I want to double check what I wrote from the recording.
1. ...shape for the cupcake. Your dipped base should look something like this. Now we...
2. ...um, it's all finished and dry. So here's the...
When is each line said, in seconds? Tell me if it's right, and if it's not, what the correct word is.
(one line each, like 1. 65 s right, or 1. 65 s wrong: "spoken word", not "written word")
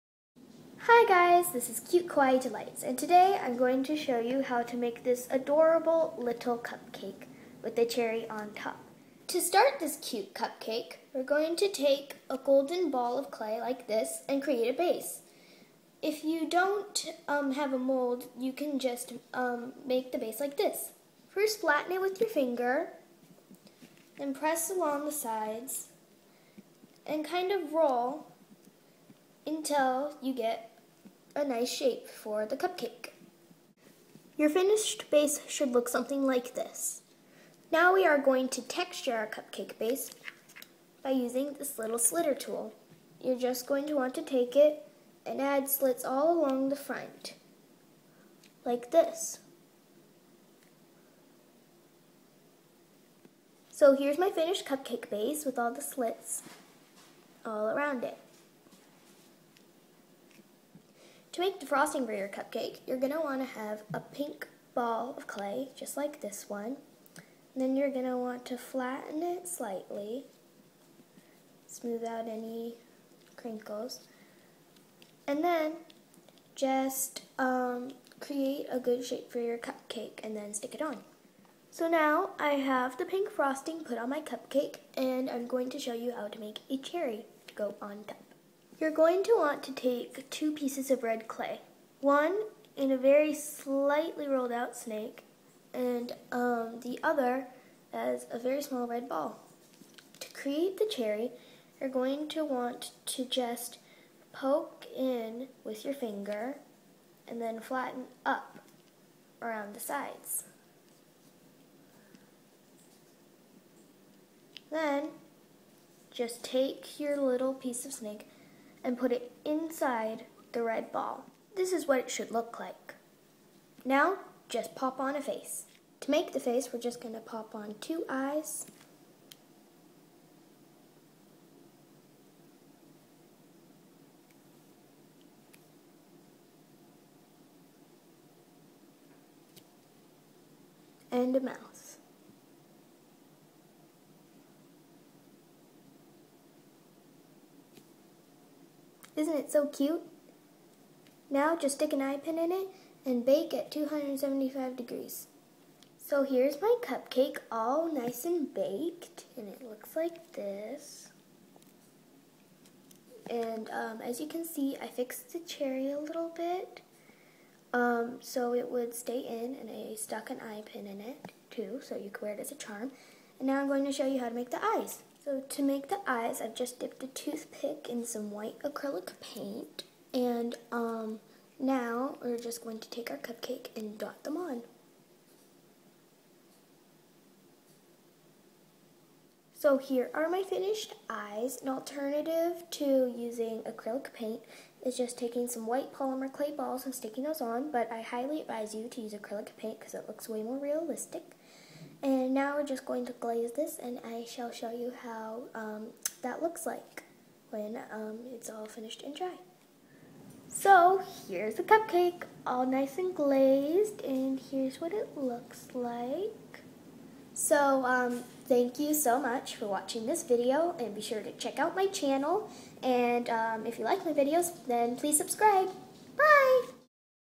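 1. 31 s wrong: "finished", not "dipped"
2. 207 s right.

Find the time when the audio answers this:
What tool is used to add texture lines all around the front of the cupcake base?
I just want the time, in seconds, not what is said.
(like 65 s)
41 s.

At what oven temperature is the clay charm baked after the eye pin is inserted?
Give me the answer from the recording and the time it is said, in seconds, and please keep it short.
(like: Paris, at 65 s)
275 degrees, at 153 s.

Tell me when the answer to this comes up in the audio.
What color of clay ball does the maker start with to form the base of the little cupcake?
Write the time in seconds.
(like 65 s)
12 s.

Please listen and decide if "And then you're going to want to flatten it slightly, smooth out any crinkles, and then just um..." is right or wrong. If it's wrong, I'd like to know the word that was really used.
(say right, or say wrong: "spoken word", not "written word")
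right.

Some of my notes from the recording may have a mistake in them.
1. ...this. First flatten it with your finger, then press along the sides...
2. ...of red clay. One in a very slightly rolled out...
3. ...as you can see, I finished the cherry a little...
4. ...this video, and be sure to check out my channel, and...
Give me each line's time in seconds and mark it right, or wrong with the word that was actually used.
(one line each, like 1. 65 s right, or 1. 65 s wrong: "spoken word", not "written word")
1. 20 s right
2. 90 s right
3. 164 s wrong: "fixed", not "finished"
4. 220 s right.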